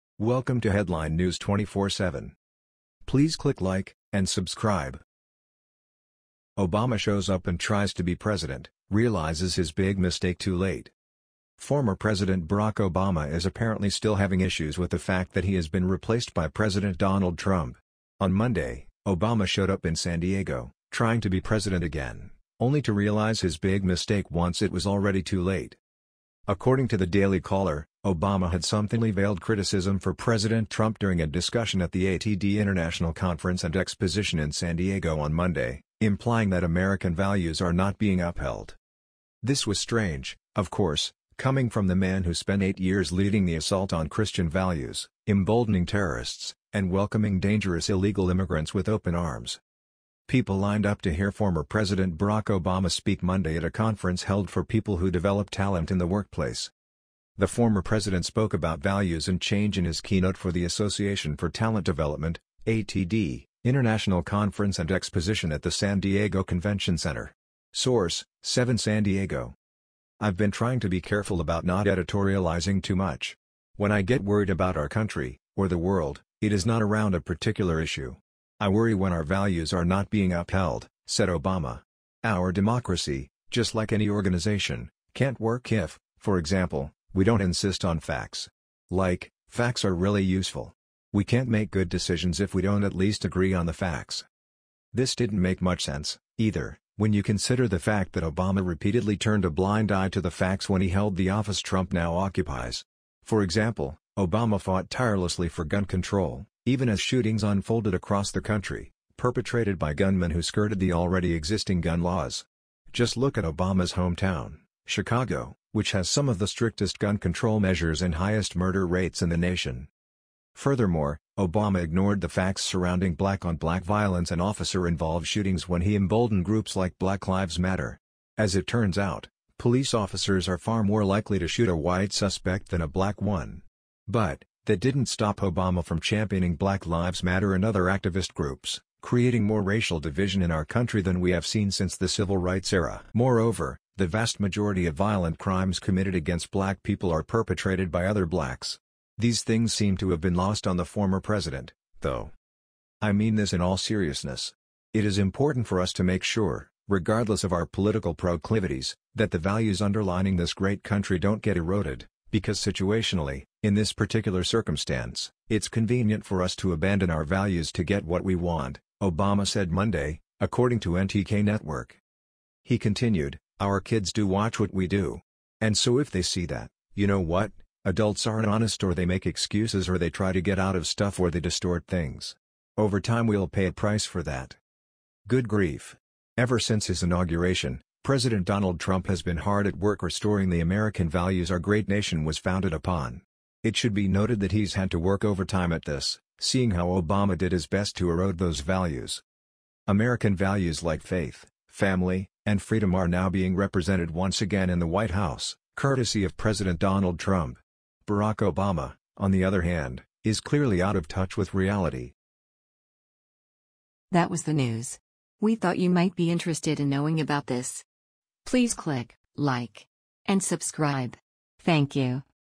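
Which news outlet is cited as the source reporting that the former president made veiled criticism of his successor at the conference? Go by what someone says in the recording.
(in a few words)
Daily Caller.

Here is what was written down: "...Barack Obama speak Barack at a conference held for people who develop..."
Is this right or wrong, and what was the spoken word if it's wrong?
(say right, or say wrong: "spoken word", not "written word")
wrong: "Monday", not "Barack".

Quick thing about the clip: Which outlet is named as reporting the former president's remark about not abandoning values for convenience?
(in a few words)
NTK Network.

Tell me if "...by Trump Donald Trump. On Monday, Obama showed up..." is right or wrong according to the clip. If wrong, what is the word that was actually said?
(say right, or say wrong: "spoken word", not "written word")
wrong: "President", not "Trump".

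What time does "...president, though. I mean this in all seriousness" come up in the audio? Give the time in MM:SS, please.
02:31.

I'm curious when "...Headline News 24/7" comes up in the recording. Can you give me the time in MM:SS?
00:00.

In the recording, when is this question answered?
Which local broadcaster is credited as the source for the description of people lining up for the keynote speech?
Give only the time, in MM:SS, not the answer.
01:08.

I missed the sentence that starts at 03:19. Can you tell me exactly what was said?
American values like faith, family, and freedom are now being represented once again in the White House, courtesy of President Donald Trump.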